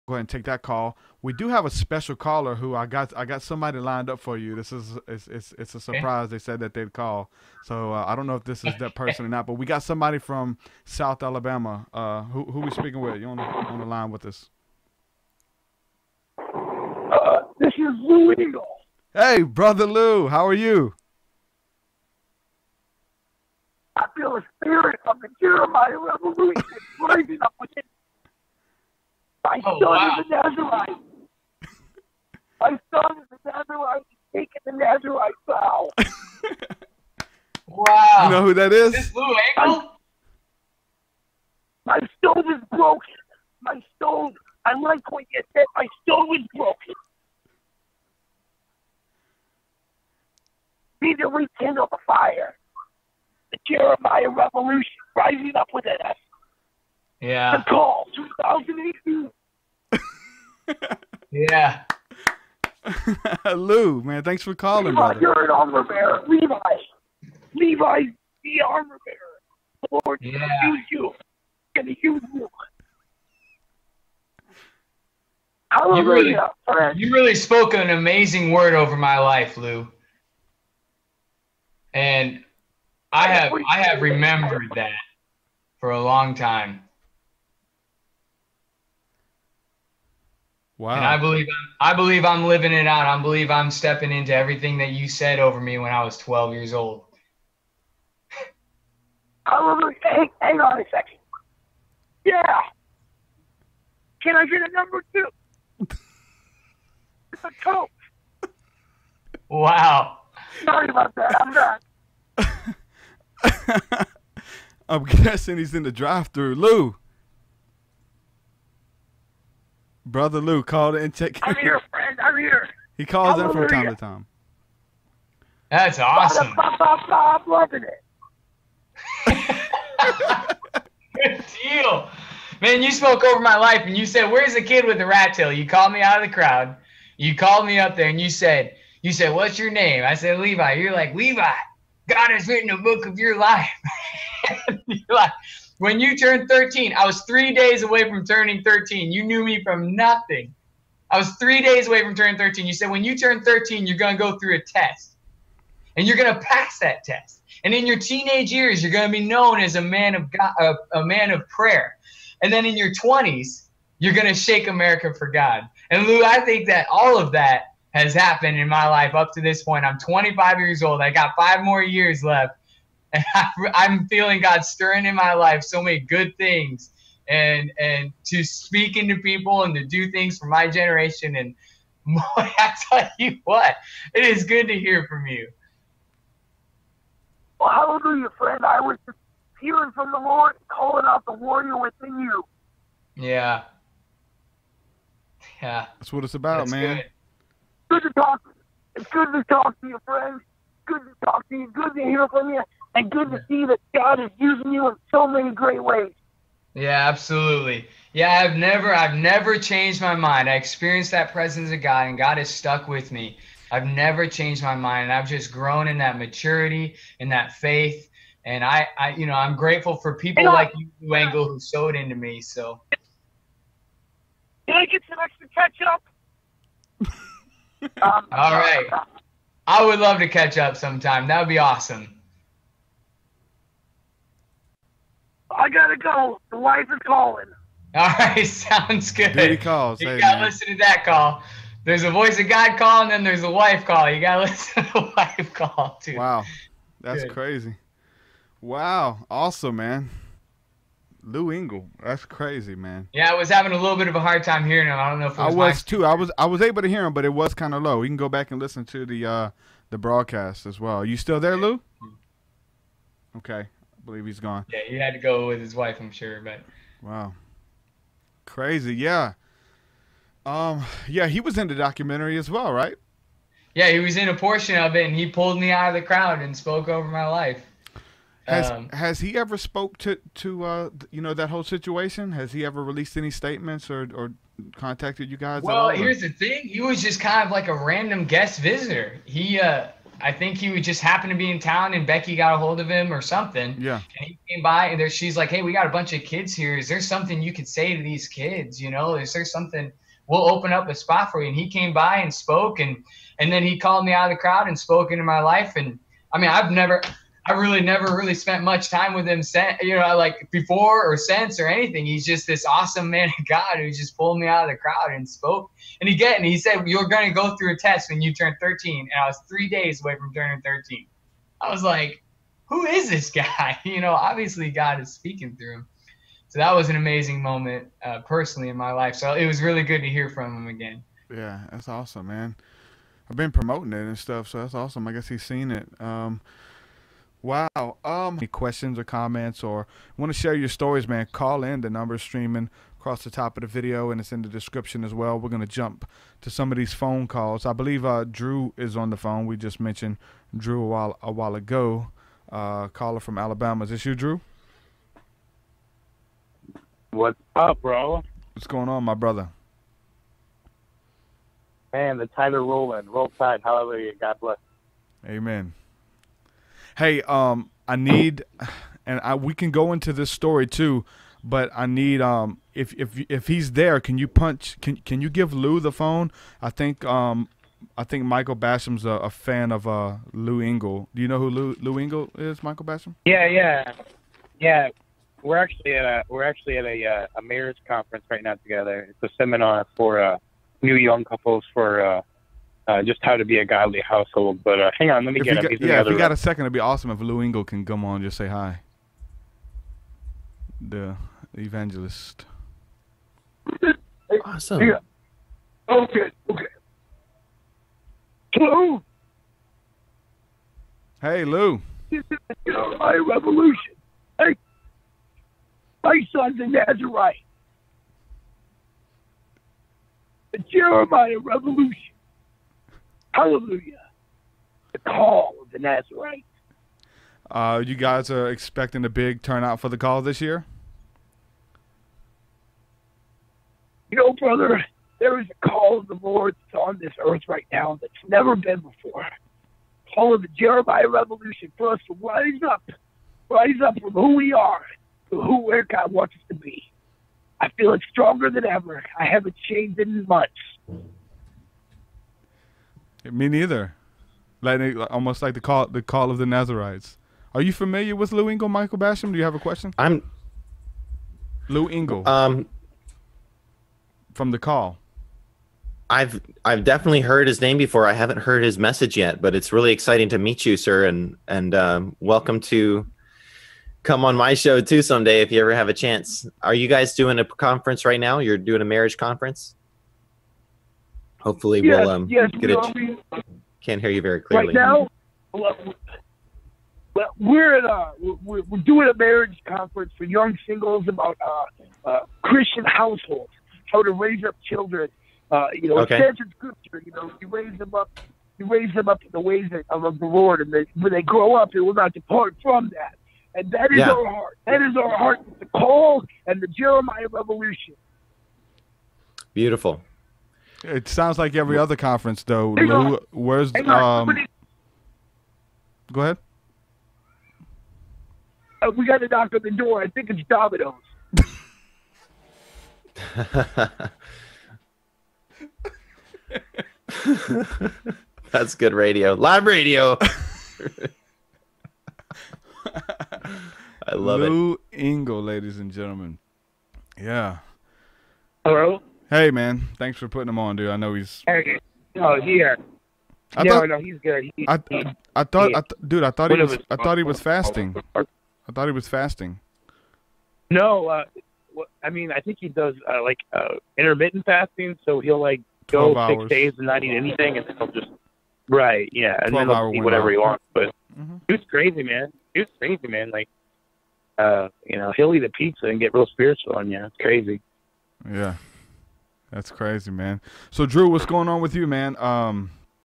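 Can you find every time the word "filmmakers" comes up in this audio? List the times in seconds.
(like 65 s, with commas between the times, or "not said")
not said.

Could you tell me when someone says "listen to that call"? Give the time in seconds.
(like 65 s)
240 s.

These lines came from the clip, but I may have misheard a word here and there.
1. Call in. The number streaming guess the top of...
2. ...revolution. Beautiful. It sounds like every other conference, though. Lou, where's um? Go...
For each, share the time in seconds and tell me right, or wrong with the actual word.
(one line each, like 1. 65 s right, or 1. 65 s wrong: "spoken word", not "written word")
1. 341 s wrong: "across", not "guess"
2. 507 s right.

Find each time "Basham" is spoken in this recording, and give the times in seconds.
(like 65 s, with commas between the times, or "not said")
378 s, 382 s, 458 s.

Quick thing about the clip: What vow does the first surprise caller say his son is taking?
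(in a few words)
Nazarite vow.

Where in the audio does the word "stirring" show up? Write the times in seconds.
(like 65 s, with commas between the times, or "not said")
174 s.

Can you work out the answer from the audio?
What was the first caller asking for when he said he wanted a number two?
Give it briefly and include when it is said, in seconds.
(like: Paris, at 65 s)
a coat, at 107 s.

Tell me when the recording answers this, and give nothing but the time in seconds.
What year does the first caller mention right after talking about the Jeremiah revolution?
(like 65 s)
58 s.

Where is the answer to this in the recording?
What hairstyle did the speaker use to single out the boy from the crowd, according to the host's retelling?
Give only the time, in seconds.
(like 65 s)
135 s.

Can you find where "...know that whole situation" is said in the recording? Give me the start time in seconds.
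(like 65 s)
281 s.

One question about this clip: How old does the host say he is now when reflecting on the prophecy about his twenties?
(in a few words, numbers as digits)
25.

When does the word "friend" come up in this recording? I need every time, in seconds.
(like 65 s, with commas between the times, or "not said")
121 s, 188 s, 200 s.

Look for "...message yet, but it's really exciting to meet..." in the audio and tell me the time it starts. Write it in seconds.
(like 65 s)
468 s.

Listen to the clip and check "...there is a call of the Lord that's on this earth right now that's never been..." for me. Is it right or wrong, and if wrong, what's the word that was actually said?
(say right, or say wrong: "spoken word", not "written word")
right.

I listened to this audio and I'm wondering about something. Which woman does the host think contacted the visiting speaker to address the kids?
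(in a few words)
Becky.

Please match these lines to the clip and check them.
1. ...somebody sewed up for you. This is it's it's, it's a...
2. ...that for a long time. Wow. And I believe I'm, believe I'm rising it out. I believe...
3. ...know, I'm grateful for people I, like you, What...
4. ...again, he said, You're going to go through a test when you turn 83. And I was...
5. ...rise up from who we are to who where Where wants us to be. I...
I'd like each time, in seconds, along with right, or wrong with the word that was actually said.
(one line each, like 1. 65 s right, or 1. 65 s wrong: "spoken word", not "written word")
1. 3 s wrong: "lined", not "sewed"
2. 84 s wrong: "living", not "rising"
3. 219 s wrong: "Engle", not "What"
4. 316 s wrong: "13", not "83"
5. 443 s wrong: "God", not "Where".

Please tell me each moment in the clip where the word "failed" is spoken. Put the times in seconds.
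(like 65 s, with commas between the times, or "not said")
not said.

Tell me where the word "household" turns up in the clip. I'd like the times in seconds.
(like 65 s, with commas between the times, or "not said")
394 s, 492 s.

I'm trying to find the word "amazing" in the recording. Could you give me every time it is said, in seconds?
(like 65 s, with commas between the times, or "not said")
77 s, 326 s.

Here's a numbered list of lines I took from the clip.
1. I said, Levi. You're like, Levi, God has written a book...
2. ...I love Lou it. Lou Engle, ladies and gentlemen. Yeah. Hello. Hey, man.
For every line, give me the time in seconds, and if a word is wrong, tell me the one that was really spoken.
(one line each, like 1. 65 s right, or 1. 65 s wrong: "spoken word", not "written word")
1. 140 s right
2. 532 s right.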